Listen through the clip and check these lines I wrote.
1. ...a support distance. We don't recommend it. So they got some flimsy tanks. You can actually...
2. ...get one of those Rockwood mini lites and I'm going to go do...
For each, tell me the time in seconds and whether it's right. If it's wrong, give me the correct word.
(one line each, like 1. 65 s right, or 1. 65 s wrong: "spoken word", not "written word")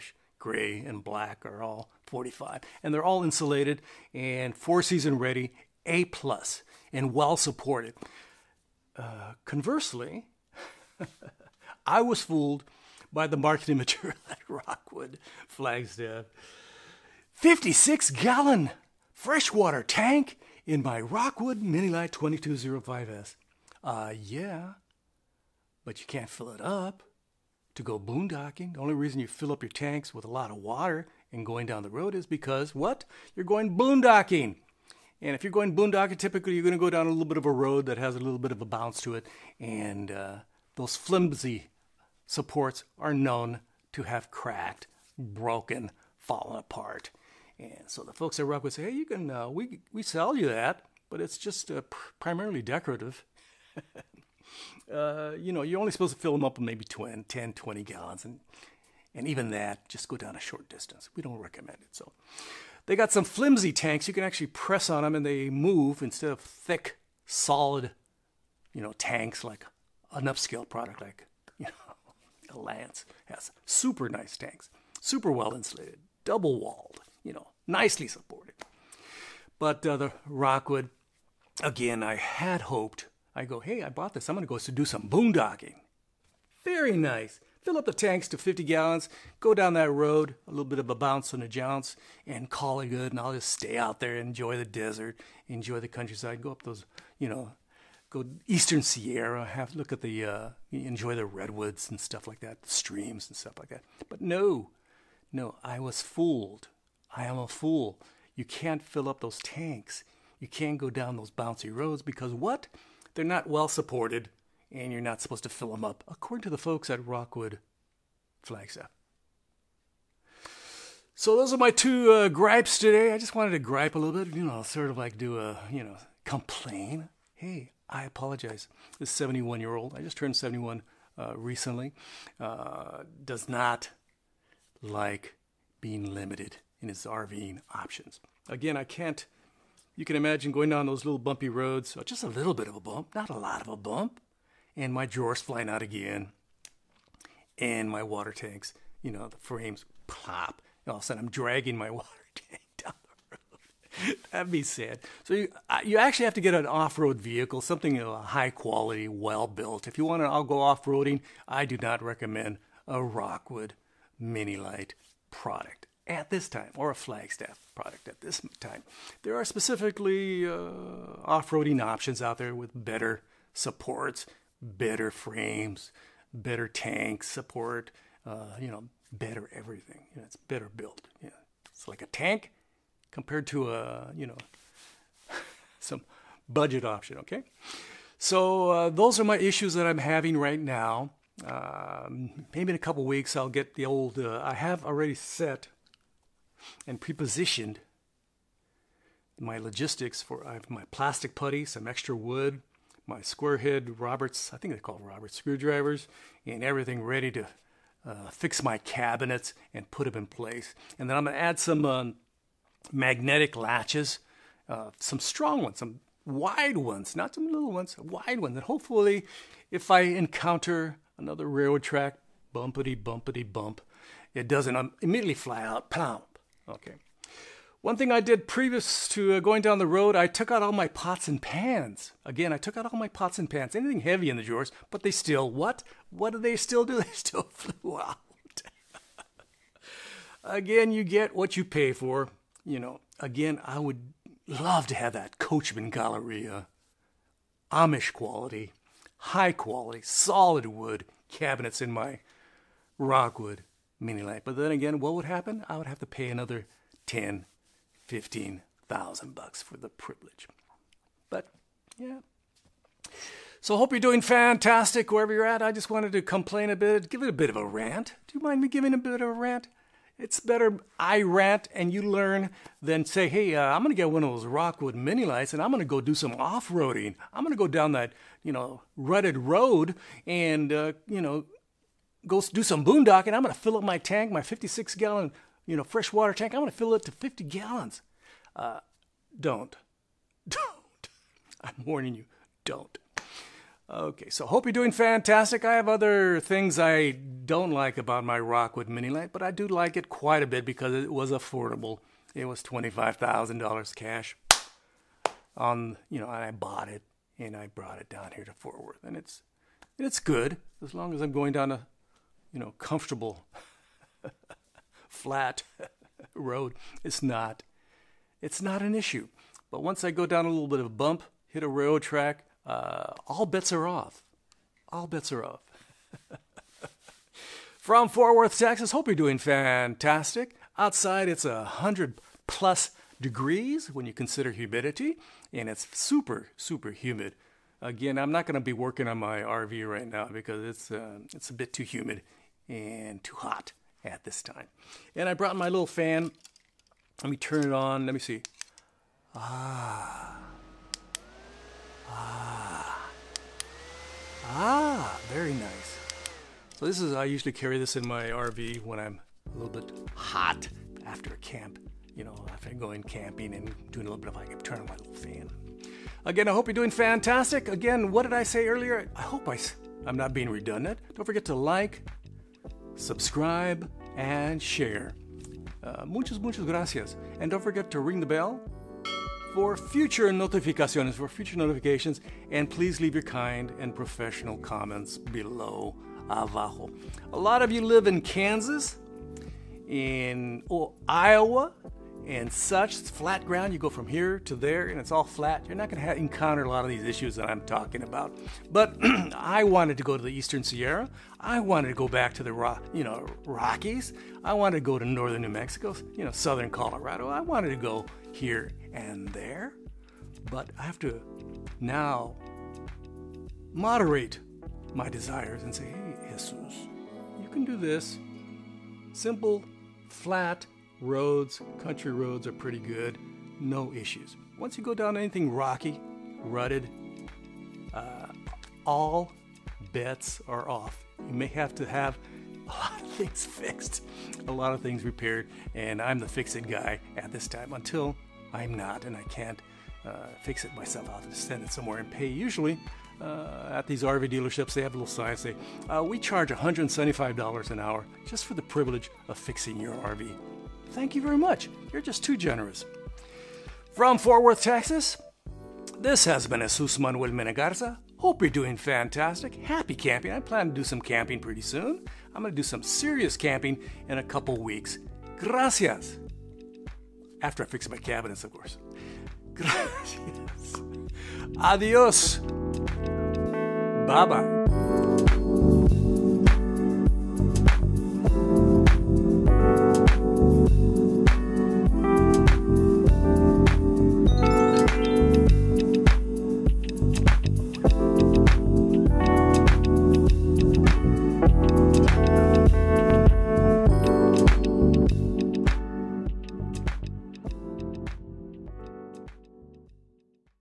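1. 60 s wrong: "short", not "support"
2. 273 s right.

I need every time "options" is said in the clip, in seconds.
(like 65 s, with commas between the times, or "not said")
137 s, 171 s, 186 s.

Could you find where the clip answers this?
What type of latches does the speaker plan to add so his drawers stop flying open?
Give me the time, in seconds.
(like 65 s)
212 s.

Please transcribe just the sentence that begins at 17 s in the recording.
56 gallon freshwater tank in my Rockwood Mini Lite 2205S.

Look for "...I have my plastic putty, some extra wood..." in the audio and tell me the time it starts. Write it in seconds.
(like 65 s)
200 s.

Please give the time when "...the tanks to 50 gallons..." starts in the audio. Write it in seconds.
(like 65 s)
87 s.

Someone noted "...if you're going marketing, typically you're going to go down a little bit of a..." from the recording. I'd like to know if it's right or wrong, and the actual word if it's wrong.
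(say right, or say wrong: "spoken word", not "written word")
wrong: "boondocking", not "marketing".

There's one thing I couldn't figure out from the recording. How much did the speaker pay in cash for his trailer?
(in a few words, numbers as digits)
$25,000.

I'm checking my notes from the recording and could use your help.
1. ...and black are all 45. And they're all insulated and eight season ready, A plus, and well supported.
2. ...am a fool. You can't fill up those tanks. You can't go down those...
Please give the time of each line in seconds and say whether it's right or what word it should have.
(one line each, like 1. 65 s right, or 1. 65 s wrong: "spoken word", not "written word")
1. 0 s wrong: "four", not "eight"
2. 107 s right.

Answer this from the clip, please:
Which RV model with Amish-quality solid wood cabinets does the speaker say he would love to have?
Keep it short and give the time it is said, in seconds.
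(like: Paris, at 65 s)
Coachmen Galleria, at 245 s.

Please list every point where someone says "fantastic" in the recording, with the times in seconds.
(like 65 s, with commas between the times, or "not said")
264 s, 294 s, 329 s, 366 s, 458 s.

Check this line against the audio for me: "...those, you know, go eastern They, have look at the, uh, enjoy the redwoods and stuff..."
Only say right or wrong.
wrong.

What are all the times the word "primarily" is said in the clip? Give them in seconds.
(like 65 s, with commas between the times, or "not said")
52 s.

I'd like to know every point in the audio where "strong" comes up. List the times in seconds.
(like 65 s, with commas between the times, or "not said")
215 s.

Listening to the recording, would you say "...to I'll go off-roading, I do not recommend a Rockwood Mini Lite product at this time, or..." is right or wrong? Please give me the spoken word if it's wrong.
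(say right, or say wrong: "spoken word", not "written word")
right.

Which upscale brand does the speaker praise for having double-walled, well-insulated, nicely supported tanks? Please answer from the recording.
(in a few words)
Lance.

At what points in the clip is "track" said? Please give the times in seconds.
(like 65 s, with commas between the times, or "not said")
221 s, 322 s.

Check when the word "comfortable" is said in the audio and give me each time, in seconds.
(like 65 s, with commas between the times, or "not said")
312 s.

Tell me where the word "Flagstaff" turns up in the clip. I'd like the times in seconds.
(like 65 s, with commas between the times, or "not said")
15 s, 118 s, 166 s.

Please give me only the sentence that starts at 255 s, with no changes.
I would have to pay another 10, 15,000 bucks for the privilege.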